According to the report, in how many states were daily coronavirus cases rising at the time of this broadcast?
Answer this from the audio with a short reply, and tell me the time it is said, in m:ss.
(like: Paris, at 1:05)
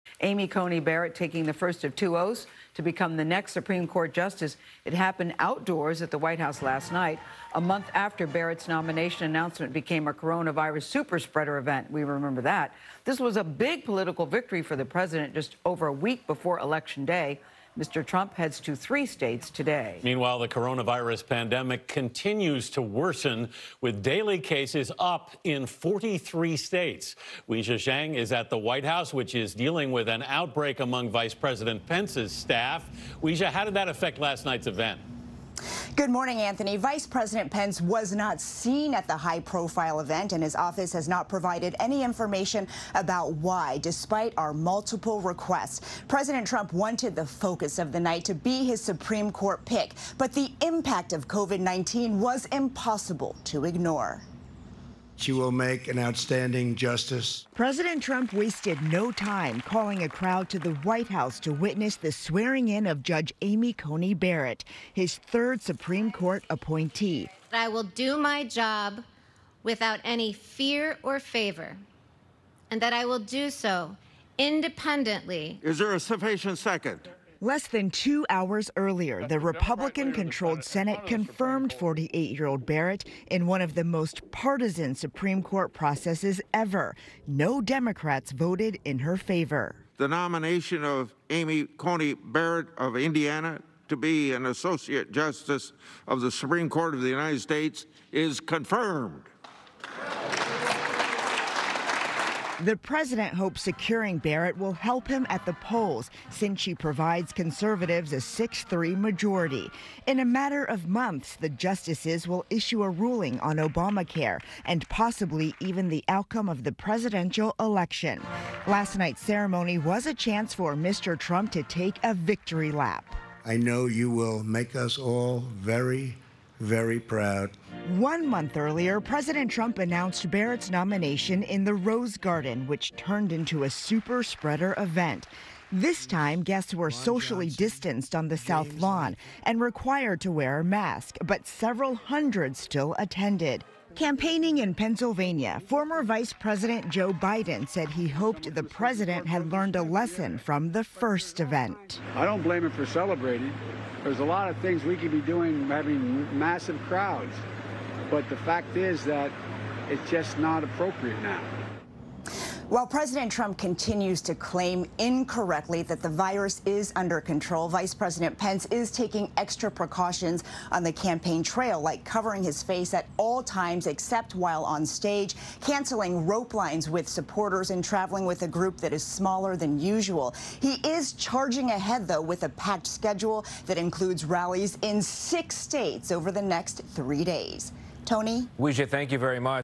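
43, at 0:25.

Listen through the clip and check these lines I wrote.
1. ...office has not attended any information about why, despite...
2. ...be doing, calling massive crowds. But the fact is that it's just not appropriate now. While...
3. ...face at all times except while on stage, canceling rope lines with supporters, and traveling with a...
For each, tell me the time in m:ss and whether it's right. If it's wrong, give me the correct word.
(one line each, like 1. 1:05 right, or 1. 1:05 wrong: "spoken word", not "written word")
1. 0:40 wrong: "provided", not "attended"
2. 2:35 wrong: "having", not "calling"
3. 2:52 right.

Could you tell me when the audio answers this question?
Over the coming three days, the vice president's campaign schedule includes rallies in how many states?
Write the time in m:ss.
3:05.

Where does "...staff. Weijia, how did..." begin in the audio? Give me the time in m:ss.
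0:32.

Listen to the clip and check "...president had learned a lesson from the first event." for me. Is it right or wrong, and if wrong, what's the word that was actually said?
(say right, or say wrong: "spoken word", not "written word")
right.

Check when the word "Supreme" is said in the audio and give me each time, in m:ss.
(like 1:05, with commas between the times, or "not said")
0:03, 0:48, 1:05, 1:24, 1:36.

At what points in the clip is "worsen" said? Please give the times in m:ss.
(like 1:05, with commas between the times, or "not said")
0:22.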